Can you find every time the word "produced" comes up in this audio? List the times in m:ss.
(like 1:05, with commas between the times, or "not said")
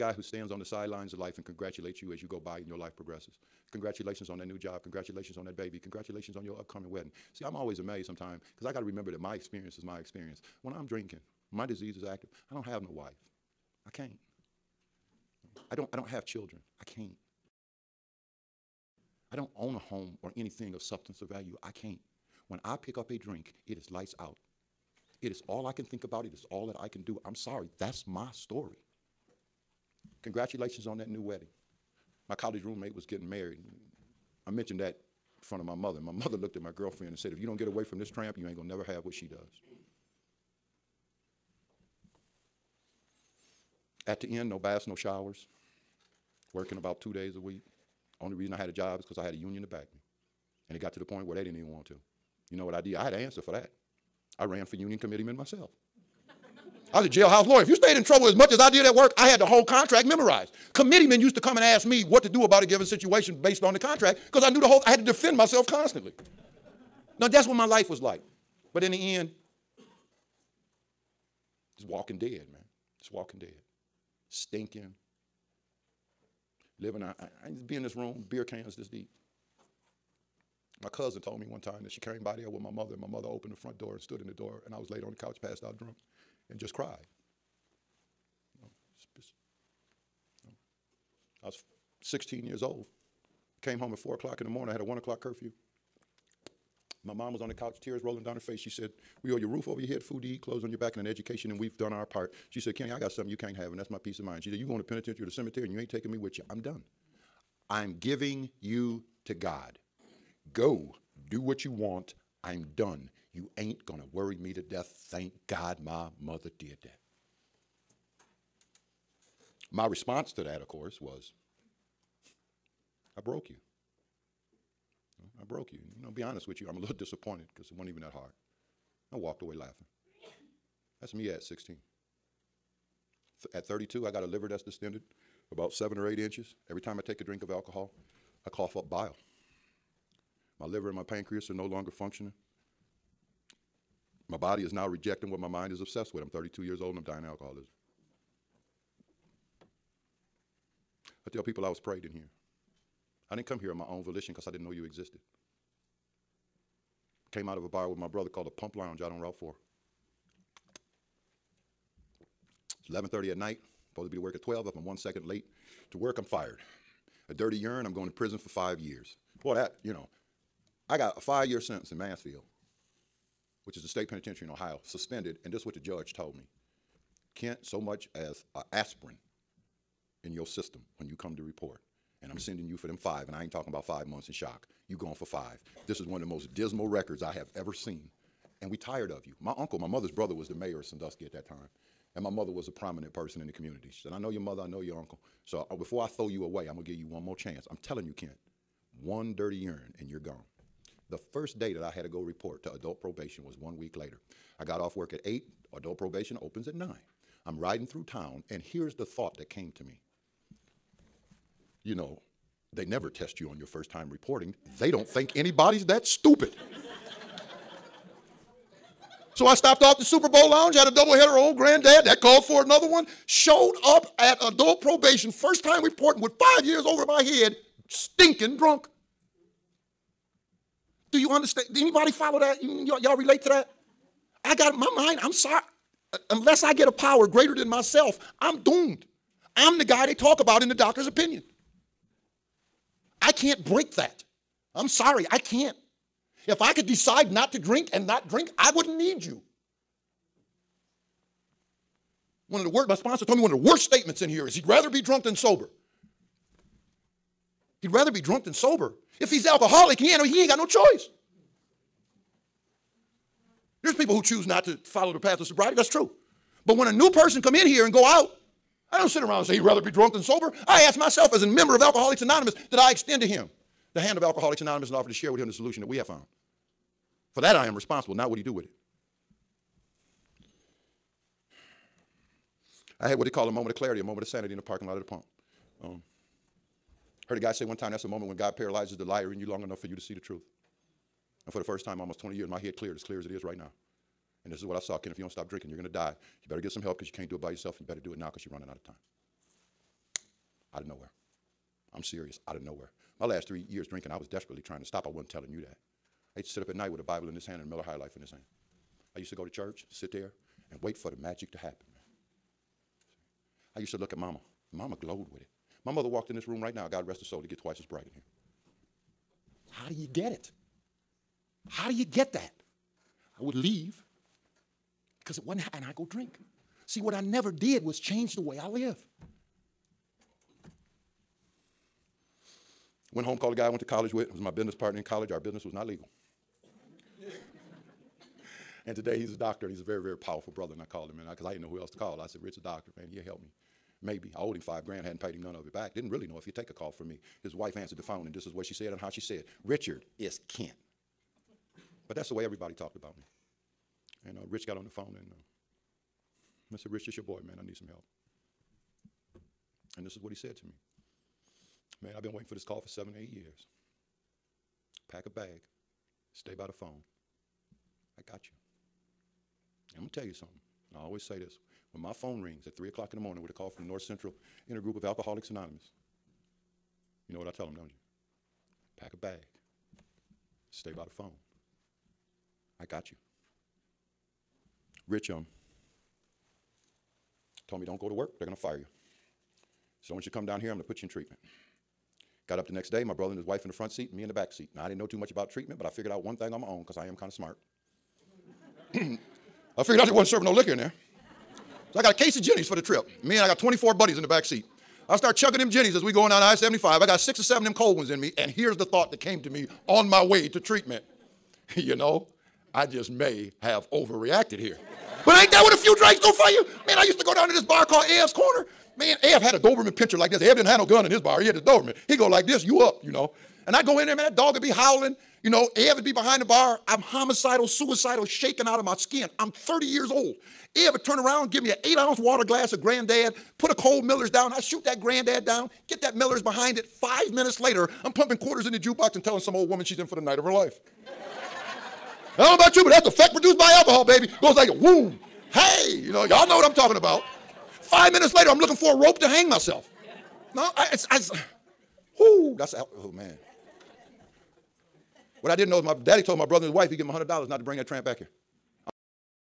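7:23.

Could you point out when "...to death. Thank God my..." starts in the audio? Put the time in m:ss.
1:54.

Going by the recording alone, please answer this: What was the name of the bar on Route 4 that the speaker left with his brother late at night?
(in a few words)
Pump Lounge.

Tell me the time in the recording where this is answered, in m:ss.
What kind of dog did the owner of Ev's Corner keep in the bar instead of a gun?
6:59.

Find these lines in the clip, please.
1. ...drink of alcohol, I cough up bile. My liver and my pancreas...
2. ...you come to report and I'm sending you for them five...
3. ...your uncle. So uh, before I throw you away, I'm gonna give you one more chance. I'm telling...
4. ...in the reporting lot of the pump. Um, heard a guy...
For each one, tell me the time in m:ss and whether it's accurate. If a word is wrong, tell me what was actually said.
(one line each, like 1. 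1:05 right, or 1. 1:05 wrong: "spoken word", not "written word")
1. 2:17 right
2. 3:01 right
3. 3:14 right
4. 4:44 wrong: "parking", not "reporting".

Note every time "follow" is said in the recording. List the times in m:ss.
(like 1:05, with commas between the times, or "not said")
3:52, 4:24.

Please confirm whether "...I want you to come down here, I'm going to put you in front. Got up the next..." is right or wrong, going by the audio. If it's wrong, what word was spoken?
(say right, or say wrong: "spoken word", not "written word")
wrong: "treatment", not "front".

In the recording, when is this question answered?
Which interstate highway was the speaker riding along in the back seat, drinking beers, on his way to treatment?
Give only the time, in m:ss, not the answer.
6:46.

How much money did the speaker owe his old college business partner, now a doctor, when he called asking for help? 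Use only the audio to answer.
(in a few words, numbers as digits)
5 grand.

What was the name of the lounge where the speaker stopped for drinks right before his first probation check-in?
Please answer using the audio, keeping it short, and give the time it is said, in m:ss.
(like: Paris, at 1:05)
Super Bowl lounge, at 3:40.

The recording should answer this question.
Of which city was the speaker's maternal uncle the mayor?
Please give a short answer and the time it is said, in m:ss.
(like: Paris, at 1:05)
Sandusky, at 3:10.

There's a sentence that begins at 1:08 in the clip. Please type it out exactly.
But in the end, just walking dead, man.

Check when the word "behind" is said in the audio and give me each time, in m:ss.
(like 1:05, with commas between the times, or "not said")
7:06, 7:16.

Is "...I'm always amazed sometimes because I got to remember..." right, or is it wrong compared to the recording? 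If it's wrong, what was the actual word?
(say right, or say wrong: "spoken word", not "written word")
right.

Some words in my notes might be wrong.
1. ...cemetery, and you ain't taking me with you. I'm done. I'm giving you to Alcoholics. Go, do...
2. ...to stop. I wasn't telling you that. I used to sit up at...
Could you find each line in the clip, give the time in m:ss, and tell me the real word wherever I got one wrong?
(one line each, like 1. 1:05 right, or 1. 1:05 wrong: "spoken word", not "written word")
1. 1:45 wrong: "God", not "Alcoholics"
2. 5:04 right.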